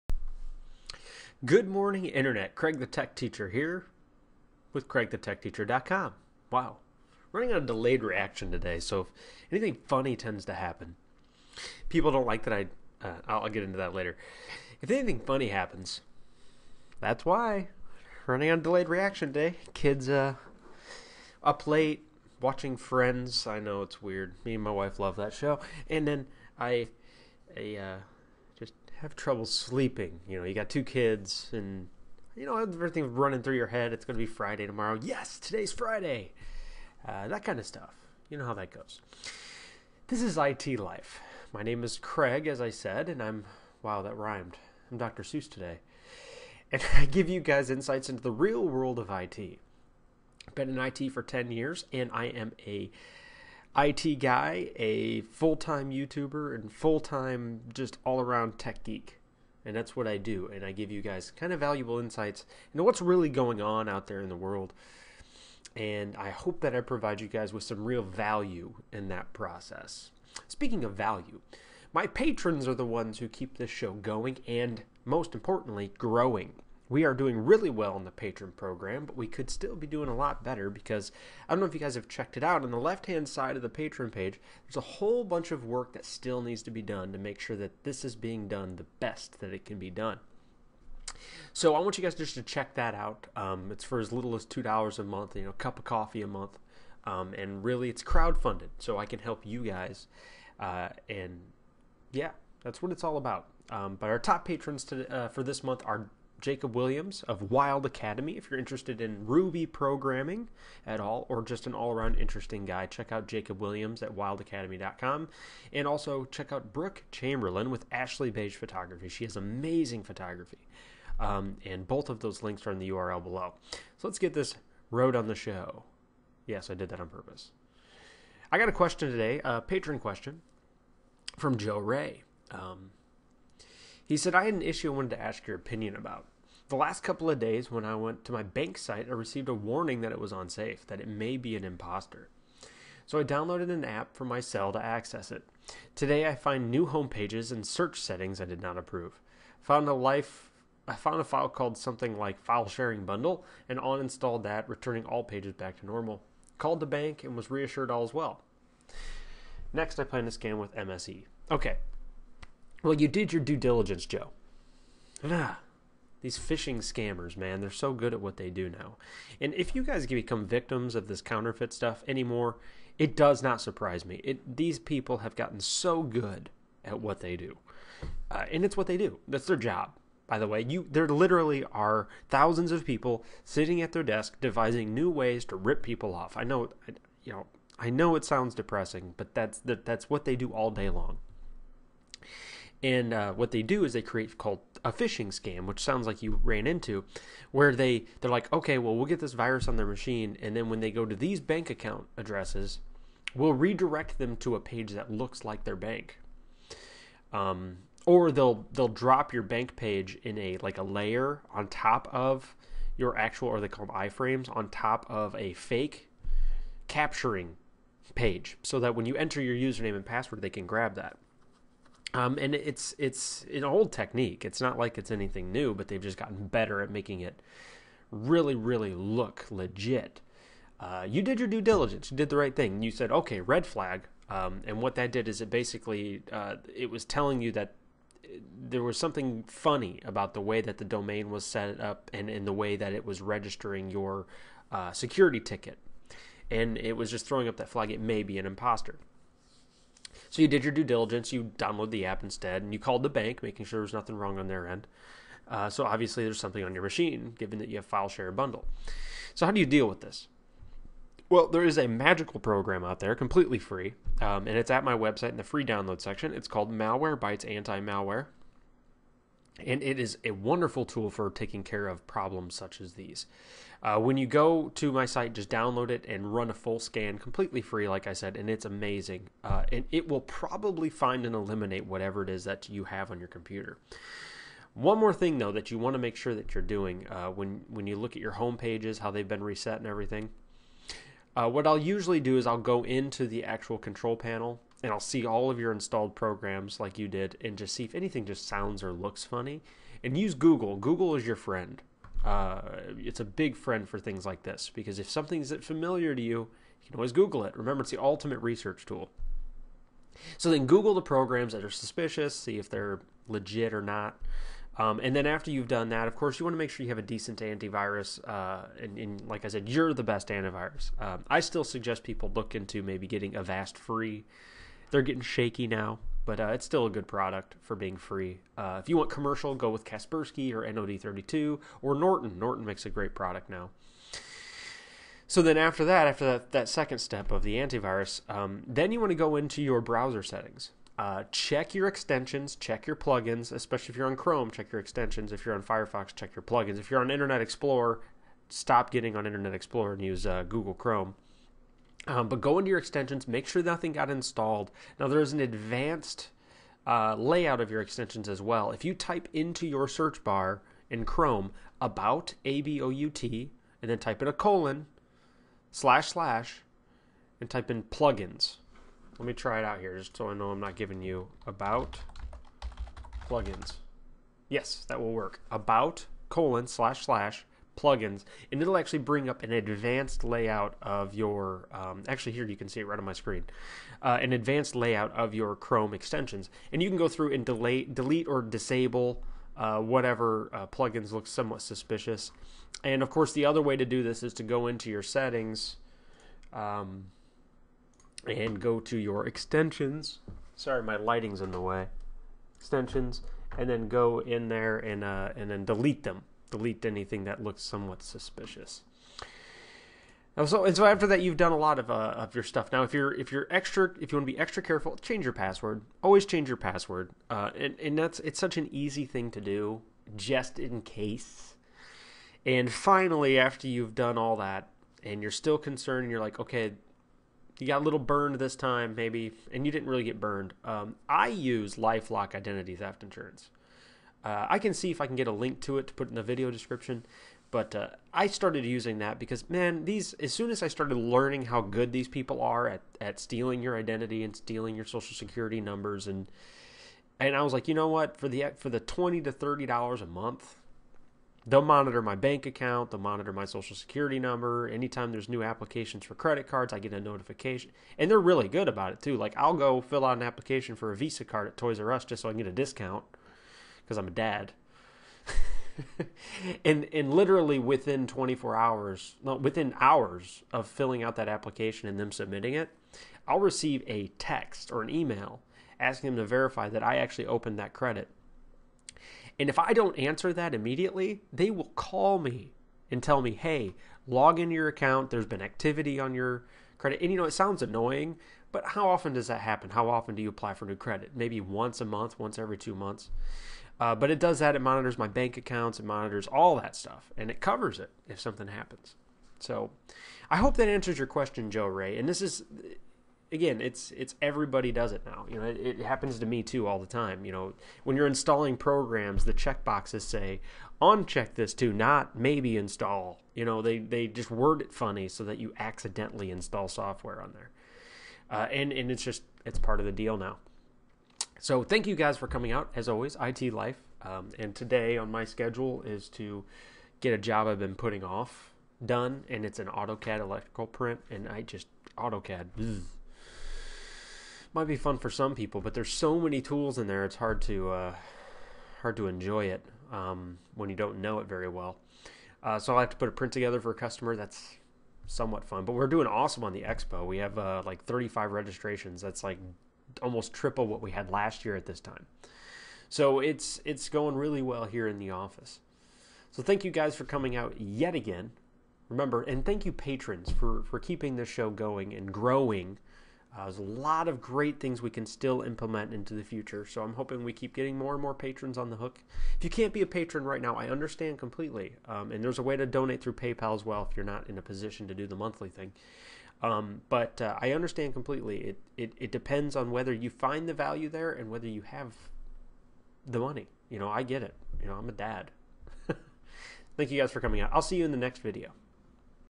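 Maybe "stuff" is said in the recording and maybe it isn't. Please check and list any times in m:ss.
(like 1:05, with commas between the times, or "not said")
0:37, 2:51, 6:52, 8:16.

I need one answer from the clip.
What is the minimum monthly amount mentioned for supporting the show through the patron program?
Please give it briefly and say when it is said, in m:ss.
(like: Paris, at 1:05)
2 dollars, at 1:34.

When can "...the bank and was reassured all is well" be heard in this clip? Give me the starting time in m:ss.
2:36.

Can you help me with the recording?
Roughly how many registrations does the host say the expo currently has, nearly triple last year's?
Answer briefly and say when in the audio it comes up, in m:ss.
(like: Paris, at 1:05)
35, at 9:07.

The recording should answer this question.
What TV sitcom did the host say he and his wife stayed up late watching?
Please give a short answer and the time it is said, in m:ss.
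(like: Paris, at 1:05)
Friends, at 0:22.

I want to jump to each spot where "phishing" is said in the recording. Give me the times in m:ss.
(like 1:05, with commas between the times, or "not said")
2:46, 3:14.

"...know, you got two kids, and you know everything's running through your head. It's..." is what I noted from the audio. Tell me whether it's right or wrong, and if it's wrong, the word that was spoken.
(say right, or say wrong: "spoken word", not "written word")
right.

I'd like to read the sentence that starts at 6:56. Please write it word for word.
Always change your password, uh, and and that's it's such an easy thing to do, just in case.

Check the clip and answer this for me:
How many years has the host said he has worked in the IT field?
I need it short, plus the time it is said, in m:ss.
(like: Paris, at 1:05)
10, at 0:51.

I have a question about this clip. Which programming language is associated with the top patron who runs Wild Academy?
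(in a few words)
Ruby.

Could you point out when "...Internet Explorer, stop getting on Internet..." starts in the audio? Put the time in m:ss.
5:47.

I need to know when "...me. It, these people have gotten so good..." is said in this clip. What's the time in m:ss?
2:54.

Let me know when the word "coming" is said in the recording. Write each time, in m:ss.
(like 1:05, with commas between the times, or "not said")
8:42, 9:17, 9:47.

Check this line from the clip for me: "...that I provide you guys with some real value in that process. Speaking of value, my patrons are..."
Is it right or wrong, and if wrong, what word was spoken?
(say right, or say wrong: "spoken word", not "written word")
right.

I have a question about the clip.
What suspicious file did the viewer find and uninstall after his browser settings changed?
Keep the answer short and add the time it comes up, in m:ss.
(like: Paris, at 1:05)
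file sharing bundle, at 2:32.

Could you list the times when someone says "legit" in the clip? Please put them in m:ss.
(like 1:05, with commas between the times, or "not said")
3:49, 5:13.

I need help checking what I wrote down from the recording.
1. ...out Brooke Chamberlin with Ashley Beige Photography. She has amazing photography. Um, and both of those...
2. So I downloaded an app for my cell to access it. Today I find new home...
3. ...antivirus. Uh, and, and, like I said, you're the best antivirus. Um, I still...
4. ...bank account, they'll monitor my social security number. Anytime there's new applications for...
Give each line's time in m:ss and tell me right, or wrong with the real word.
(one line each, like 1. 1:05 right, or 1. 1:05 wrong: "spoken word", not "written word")
1. 1:56 right
2. 2:23 right
3. 5:17 right
4. 7:32 right.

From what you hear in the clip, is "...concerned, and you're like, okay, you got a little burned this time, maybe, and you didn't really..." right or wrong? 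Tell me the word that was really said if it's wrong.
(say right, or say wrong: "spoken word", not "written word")
right.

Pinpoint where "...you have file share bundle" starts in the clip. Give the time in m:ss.
4:17.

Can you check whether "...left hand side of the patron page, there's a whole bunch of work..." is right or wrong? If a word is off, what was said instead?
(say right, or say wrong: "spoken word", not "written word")
right.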